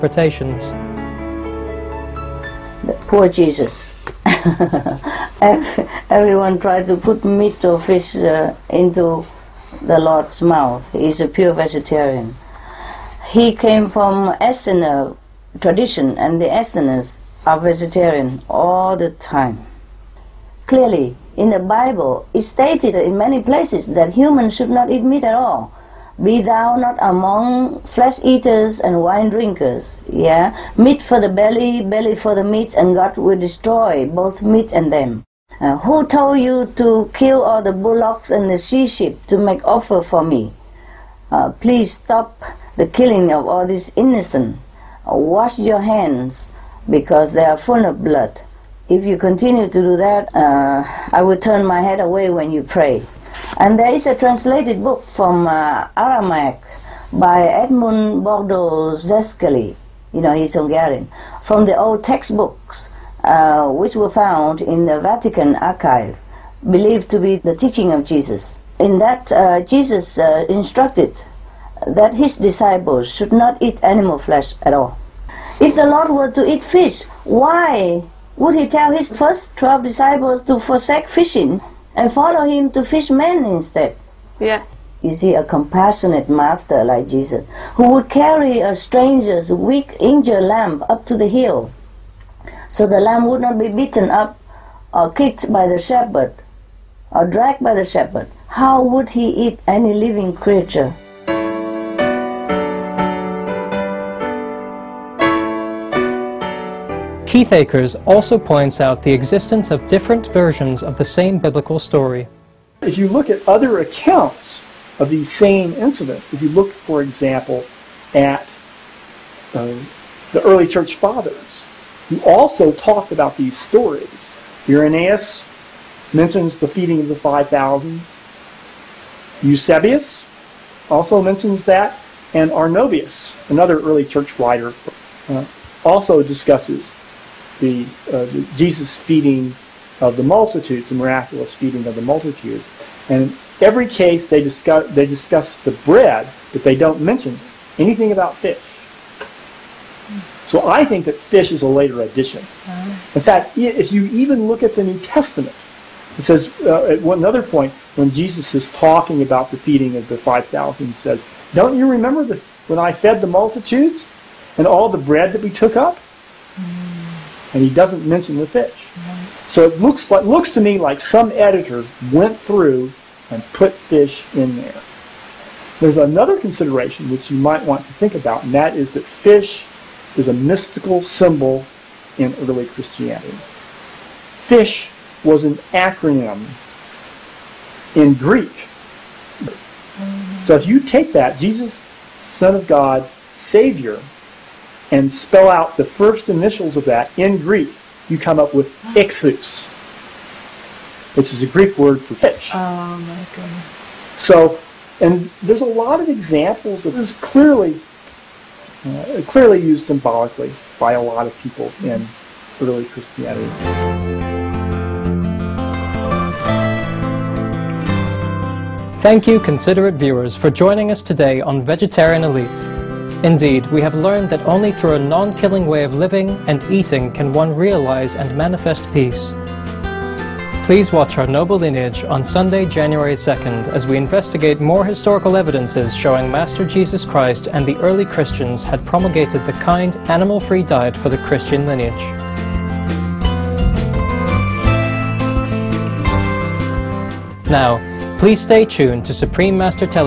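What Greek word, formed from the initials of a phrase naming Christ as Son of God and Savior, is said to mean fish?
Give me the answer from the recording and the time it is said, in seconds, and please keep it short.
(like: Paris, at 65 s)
ichthus, at 198 s.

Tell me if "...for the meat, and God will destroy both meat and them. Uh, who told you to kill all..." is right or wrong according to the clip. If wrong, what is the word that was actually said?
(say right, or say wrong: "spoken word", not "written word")
right.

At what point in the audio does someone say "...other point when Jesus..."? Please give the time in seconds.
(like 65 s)
157 s.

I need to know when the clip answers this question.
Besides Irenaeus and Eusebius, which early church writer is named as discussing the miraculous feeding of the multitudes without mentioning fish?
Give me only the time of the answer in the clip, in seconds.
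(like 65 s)
132 s.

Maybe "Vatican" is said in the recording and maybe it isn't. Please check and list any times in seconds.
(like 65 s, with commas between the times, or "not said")
64 s.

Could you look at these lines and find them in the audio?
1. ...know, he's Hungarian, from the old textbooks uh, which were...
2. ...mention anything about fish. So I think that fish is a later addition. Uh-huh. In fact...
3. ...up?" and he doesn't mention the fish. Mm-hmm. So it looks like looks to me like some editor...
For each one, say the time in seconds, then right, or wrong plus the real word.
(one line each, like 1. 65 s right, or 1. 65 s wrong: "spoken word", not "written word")
1. 60 s right
2. 147 s right
3. 165 s right.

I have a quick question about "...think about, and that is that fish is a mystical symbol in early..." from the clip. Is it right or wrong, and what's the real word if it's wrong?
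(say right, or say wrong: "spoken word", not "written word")
right.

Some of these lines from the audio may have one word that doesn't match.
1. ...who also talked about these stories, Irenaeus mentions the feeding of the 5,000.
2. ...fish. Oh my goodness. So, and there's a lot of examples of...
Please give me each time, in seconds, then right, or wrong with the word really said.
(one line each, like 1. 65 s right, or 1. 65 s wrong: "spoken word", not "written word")
1. 122 s right
2. 202 s right.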